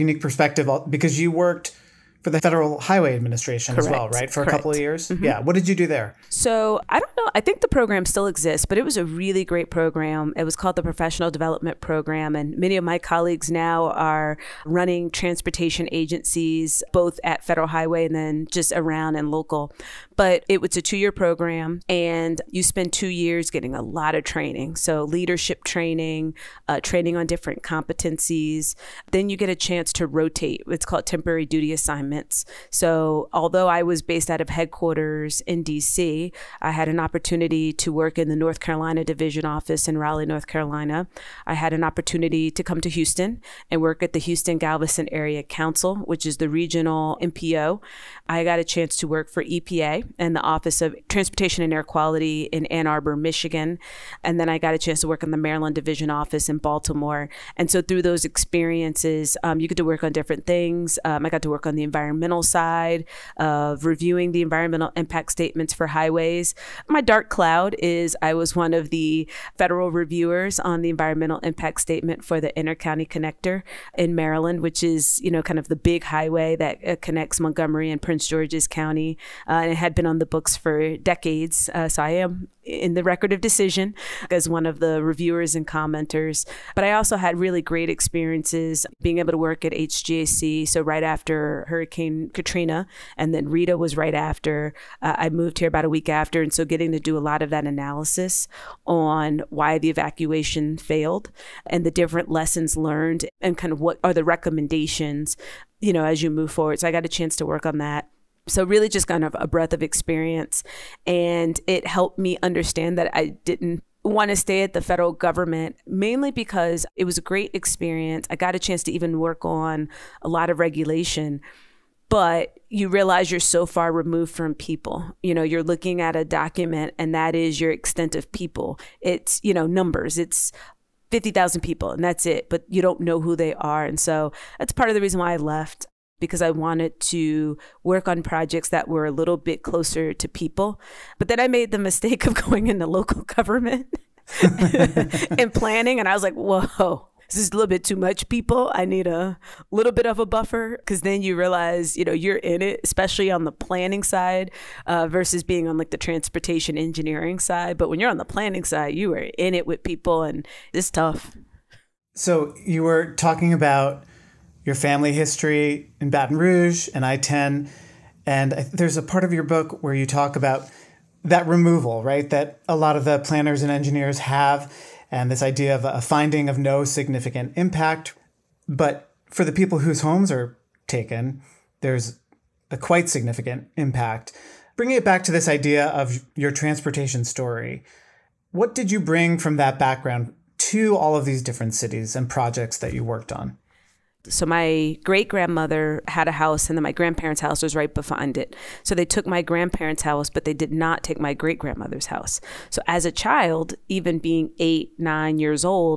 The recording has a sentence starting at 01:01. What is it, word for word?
Um, I got to work on the environmental side of reviewing the environmental impact statements for highways ways.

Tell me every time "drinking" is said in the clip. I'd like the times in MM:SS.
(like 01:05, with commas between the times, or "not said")
not said.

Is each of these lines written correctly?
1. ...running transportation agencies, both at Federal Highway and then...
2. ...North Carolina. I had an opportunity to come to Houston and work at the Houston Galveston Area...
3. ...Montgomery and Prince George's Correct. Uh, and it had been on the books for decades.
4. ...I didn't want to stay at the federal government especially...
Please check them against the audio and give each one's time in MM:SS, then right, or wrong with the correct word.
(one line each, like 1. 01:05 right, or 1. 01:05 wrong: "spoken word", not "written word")
1. 00:14 right
2. 00:40 right
3. 01:17 wrong: "County", not "Correct"
4. 01:53 wrong: "mainly", not "especially".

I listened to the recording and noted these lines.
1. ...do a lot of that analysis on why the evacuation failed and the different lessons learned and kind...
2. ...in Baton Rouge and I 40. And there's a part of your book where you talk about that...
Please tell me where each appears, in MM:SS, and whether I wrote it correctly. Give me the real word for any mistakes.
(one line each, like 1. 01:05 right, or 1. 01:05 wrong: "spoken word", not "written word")
1. 01:36 right
2. 02:46 wrong: "10", not "40".